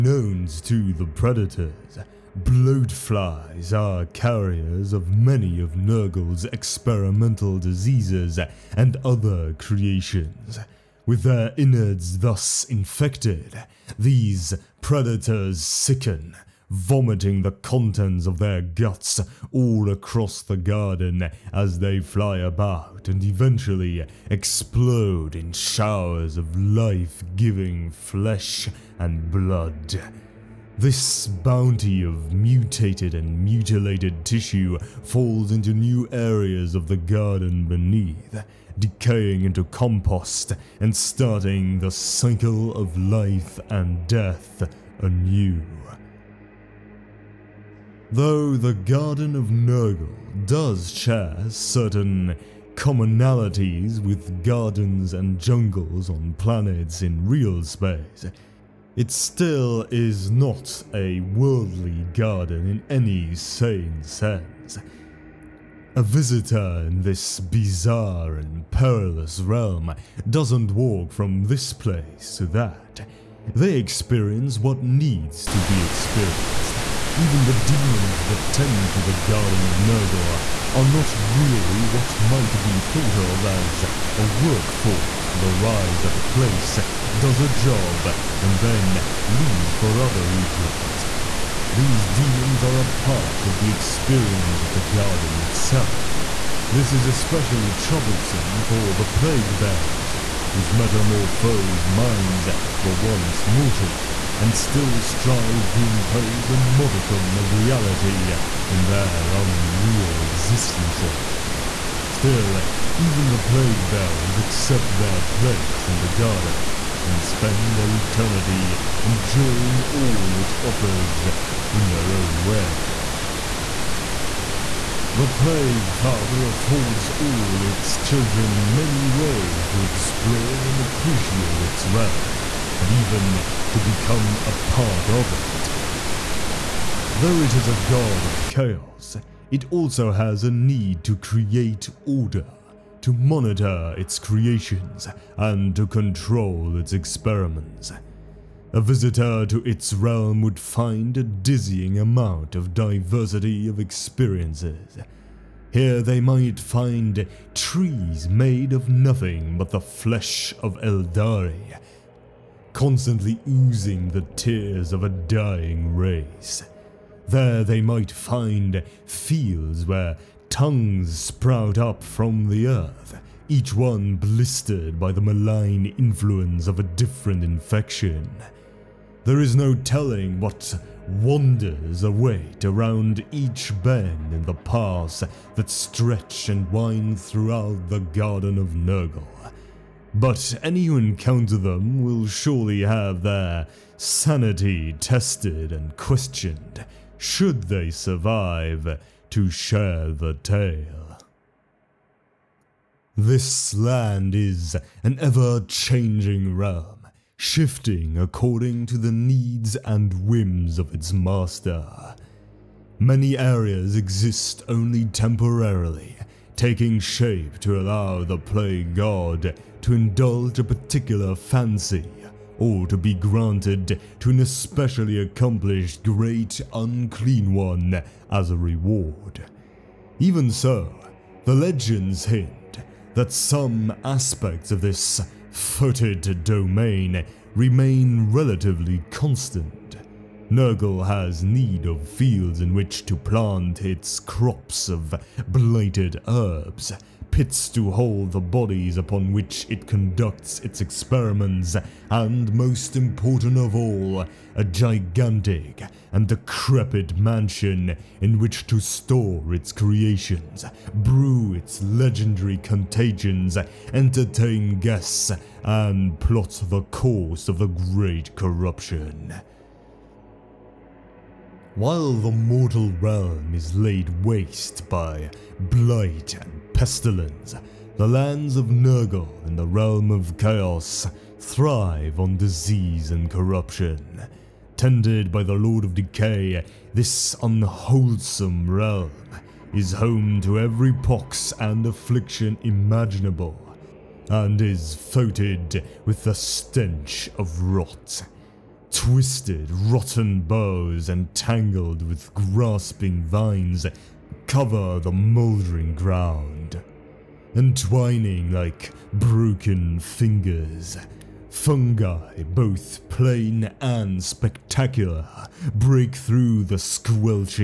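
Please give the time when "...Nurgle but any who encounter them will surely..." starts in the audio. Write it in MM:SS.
03:08.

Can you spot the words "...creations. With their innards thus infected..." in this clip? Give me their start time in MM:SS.
00:09.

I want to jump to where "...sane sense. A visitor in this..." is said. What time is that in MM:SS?
01:03.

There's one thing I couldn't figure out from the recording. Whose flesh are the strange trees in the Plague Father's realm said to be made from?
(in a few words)
Aeldari.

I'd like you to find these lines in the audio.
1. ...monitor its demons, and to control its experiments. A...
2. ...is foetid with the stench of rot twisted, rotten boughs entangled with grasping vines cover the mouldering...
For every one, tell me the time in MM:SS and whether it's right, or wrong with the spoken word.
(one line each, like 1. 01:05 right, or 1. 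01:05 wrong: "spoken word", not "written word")
1. 02:23 wrong: "creations", not "demons"
2. 04:54 right.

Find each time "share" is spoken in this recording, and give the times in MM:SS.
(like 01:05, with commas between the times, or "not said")
00:50, 03:19.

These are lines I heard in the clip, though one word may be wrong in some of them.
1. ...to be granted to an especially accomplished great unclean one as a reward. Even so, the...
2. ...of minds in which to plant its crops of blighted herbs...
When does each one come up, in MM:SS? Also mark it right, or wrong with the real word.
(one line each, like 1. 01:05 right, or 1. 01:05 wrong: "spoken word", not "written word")
1. 03:42 right
2. 04:01 wrong: "fields", not "minds".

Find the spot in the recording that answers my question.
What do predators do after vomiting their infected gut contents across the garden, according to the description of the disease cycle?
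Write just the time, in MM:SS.
00:24.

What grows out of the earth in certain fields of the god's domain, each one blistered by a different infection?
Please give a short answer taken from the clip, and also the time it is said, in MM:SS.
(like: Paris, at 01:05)
Tongues, at 02:50.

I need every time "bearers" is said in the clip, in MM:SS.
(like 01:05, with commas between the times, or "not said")
01:39, 01:53.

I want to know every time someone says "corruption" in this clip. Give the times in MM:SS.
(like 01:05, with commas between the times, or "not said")
04:28, 04:43.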